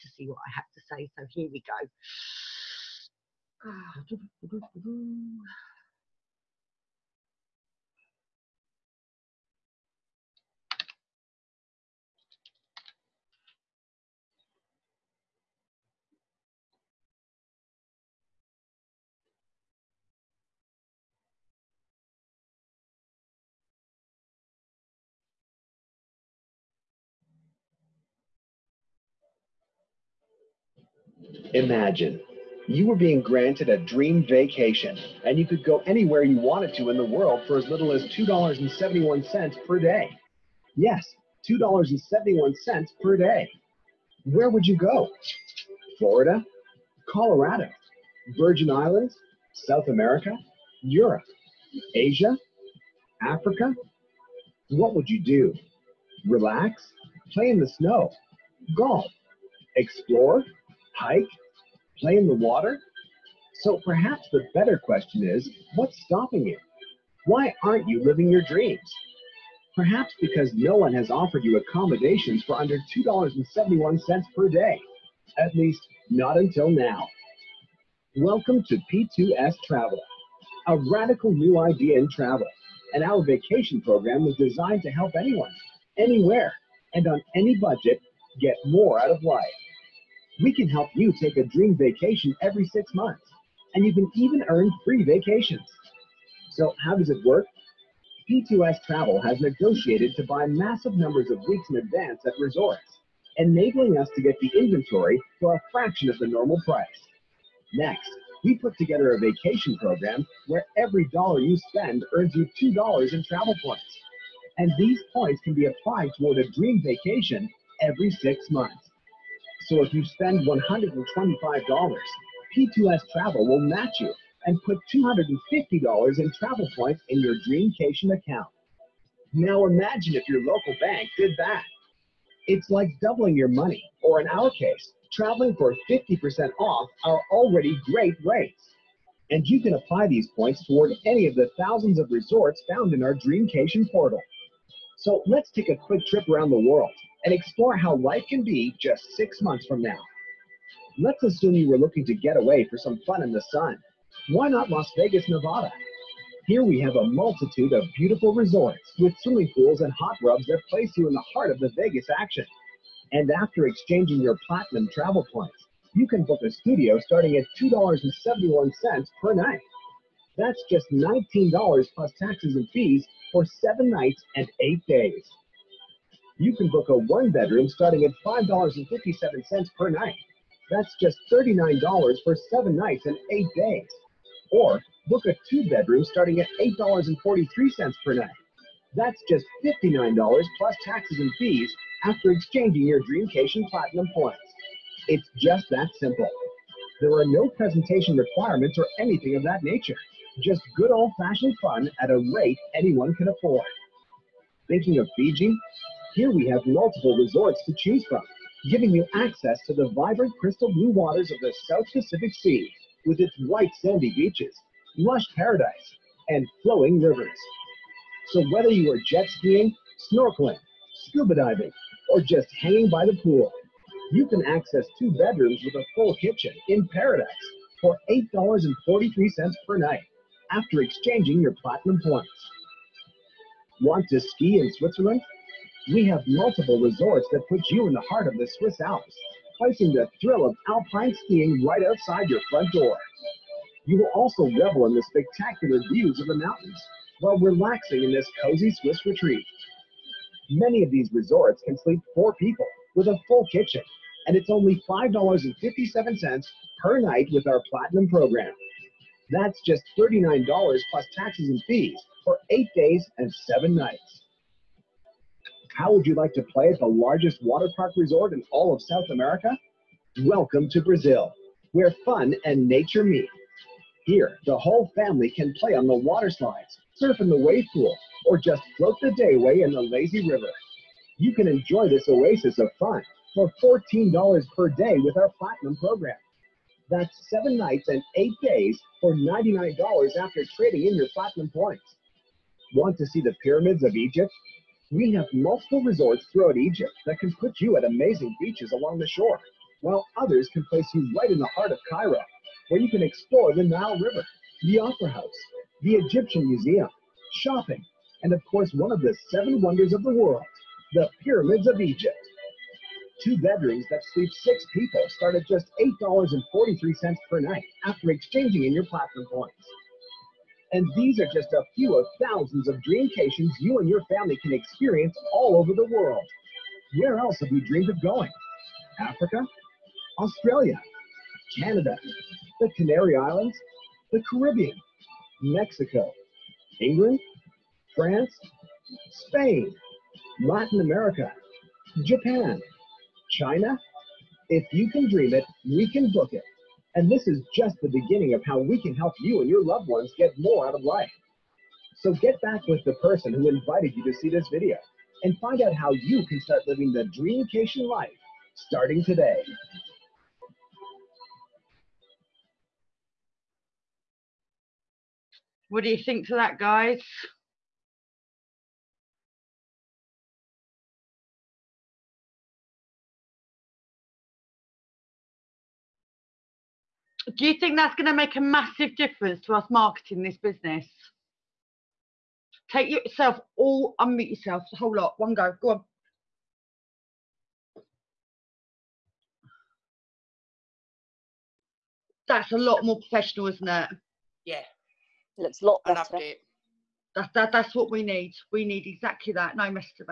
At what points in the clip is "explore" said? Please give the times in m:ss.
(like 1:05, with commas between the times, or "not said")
0:59, 2:27, 5:03.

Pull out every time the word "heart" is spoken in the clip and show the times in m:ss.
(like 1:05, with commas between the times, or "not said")
2:41, 3:58, 5:01.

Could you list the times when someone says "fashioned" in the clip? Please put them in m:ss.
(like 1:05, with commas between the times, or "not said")
3:21.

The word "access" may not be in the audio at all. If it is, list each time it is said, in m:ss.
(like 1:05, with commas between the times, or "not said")
3:29, 3:44.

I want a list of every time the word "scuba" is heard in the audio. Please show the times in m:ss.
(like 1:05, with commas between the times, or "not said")
3:41.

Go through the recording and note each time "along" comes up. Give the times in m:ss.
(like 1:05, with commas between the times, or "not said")
4:58.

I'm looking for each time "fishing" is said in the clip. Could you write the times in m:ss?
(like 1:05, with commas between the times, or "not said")
not said.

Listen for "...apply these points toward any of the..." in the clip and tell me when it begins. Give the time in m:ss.
2:19.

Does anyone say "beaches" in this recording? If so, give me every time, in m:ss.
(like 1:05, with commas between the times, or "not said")
3:34, 4:58.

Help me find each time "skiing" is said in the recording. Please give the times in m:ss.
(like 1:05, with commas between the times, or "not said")
3:39, 4:01.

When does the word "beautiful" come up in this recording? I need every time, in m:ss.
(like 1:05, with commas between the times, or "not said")
2:37.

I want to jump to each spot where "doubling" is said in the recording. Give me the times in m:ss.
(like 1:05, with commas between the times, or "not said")
2:13.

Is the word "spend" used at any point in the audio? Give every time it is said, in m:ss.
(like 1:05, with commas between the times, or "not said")
1:51, 2:00.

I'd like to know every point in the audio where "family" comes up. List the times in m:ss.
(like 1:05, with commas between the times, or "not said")
4:34, 5:24.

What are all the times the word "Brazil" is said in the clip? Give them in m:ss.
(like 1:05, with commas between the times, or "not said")
4:30.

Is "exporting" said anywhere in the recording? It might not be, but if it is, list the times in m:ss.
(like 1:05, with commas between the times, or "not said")
not said.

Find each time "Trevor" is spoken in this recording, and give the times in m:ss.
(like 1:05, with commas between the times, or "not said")
not said.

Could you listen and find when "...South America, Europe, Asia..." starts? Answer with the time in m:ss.
0:49.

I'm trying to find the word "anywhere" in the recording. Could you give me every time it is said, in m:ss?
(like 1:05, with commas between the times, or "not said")
0:35, 1:25.